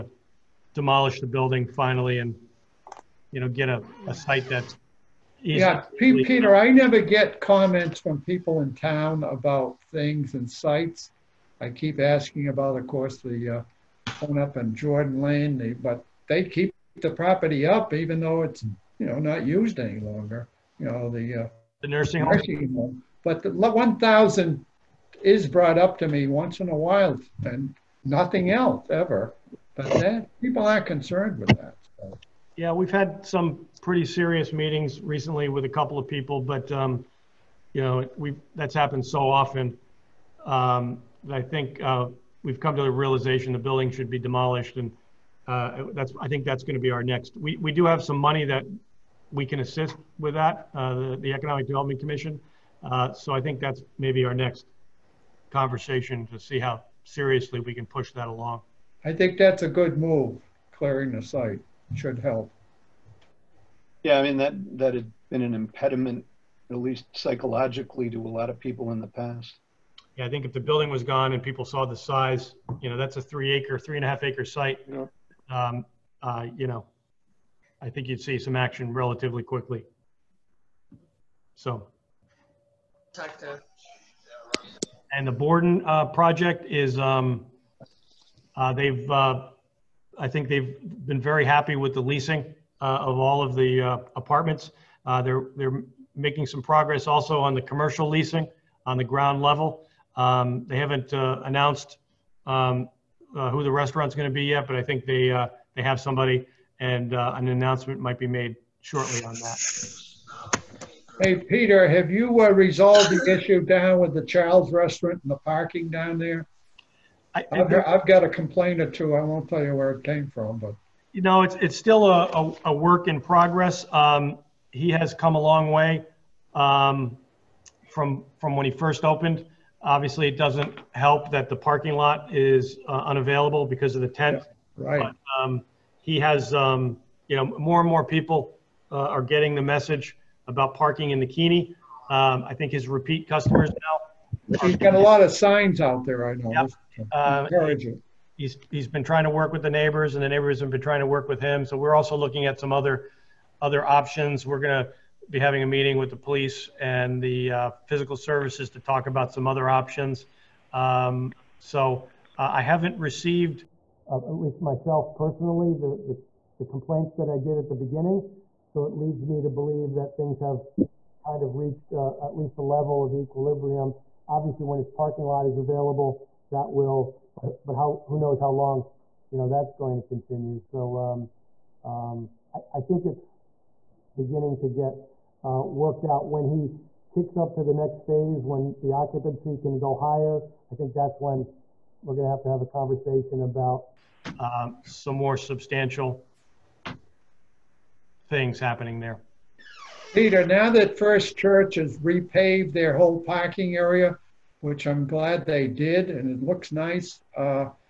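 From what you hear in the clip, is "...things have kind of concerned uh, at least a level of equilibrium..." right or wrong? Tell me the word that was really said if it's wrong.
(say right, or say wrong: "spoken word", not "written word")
wrong: "reached", not "concerned".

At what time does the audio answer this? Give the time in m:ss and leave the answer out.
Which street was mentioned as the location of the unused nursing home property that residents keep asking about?
0:14.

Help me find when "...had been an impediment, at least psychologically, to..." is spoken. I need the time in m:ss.
1:04.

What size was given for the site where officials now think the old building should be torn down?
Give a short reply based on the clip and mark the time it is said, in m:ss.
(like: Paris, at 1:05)
3.5 acres, at 1:13.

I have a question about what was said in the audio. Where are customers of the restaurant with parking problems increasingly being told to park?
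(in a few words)
the Keeney.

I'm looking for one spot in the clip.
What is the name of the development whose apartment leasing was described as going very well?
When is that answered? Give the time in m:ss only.
1:25.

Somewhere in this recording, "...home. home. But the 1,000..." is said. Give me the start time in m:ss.
0:22.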